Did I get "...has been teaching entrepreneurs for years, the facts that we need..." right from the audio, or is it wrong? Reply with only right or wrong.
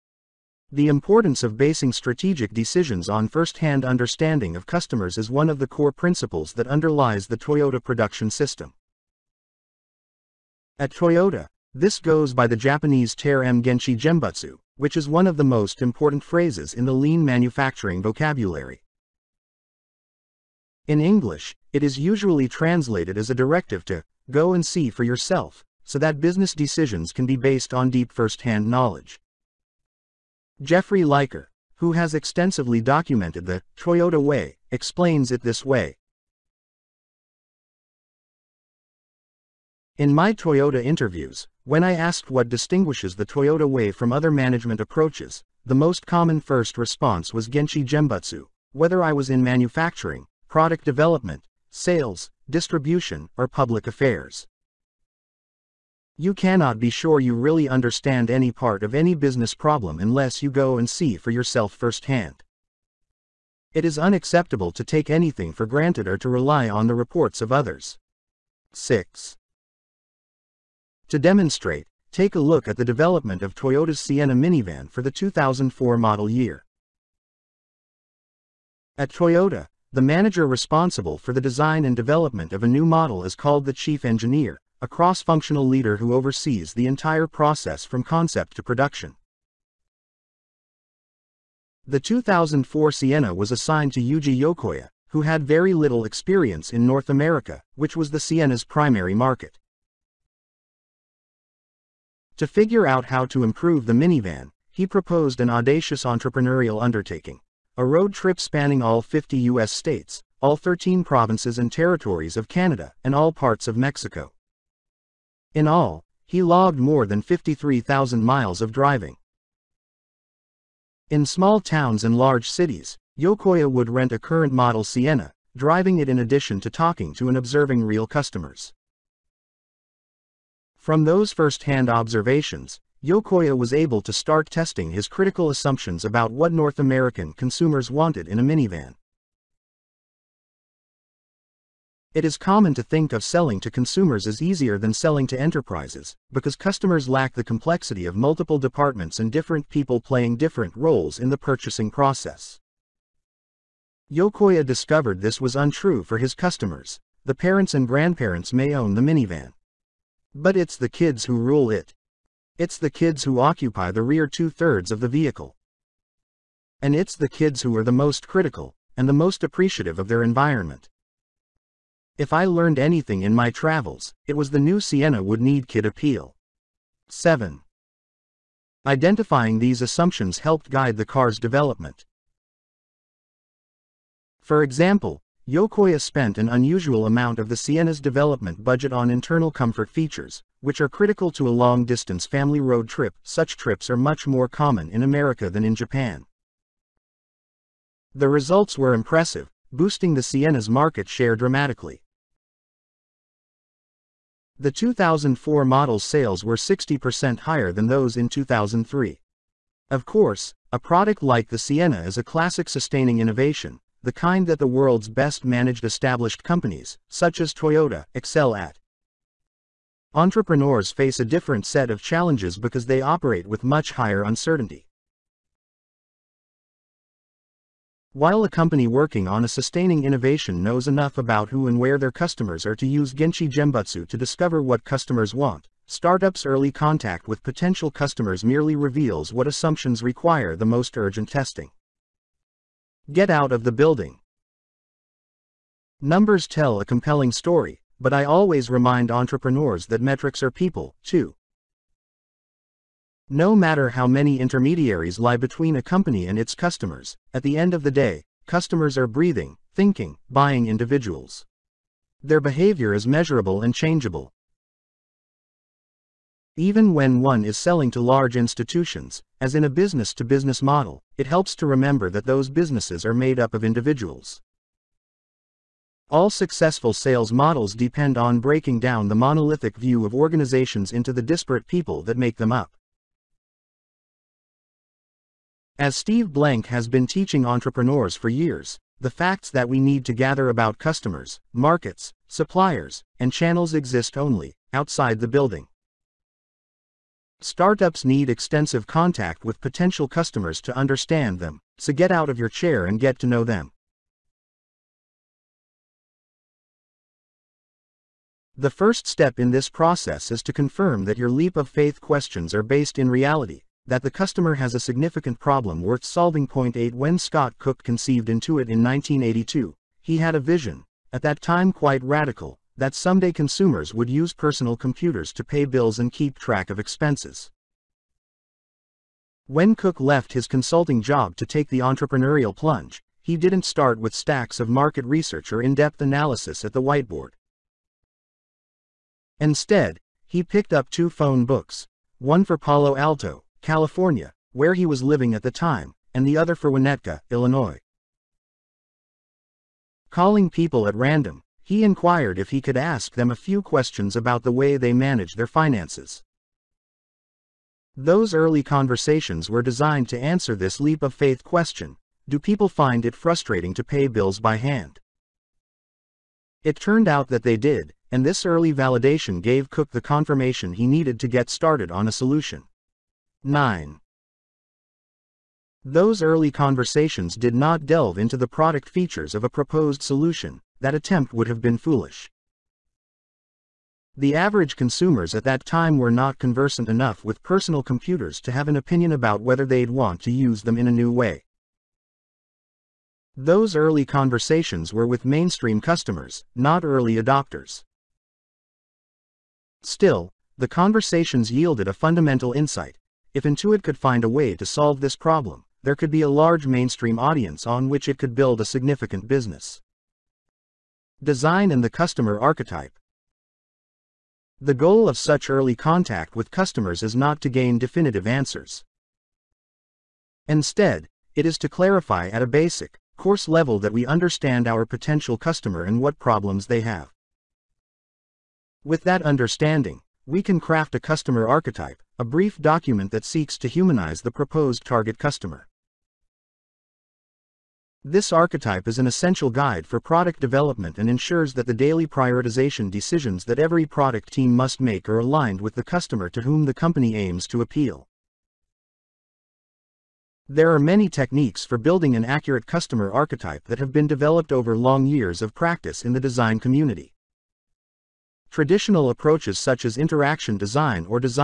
right.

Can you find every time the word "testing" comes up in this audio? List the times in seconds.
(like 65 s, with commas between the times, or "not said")
134 s, 241 s.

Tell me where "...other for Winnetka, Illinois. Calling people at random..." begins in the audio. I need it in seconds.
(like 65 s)
346 s.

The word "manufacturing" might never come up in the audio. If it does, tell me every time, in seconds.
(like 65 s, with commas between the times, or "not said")
17 s, 49 s.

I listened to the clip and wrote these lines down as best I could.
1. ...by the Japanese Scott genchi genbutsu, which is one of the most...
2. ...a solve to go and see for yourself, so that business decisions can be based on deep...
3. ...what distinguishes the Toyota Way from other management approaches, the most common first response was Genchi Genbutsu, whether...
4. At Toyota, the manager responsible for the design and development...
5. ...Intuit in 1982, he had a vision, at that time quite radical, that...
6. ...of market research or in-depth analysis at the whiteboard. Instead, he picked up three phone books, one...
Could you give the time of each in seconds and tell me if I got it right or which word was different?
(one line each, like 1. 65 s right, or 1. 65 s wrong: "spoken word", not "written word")
1. 12 s wrong: "Terem", not "Scott"
2. 23 s wrong: "directive", not "solve"
3. 42 s right
4. 78 s right
5. 318 s right
6. 334 s wrong: "two", not "three".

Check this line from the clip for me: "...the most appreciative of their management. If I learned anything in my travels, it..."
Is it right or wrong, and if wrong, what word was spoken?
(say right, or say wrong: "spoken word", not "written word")
wrong: "environment", not "management".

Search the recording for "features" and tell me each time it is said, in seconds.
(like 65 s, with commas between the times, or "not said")
189 s, 378 s.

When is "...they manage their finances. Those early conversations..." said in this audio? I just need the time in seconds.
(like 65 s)
354 s.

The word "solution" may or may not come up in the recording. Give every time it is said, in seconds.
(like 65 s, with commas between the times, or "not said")
372 s, 380 s.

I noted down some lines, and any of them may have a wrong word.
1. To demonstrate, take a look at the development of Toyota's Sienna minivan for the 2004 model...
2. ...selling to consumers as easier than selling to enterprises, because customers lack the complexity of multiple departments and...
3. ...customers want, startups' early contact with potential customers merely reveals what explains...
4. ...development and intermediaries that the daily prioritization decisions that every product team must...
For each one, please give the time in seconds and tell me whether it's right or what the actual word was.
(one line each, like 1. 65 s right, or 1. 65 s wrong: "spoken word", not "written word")
1. 71 s right
2. 143 s right
3. 234 s wrong: "assumptions", not "explains"
4. 440 s wrong: "ensures", not "intermediaries".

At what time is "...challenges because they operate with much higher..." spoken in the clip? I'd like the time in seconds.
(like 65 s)
222 s.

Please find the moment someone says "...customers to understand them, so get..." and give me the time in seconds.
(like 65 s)
300 s.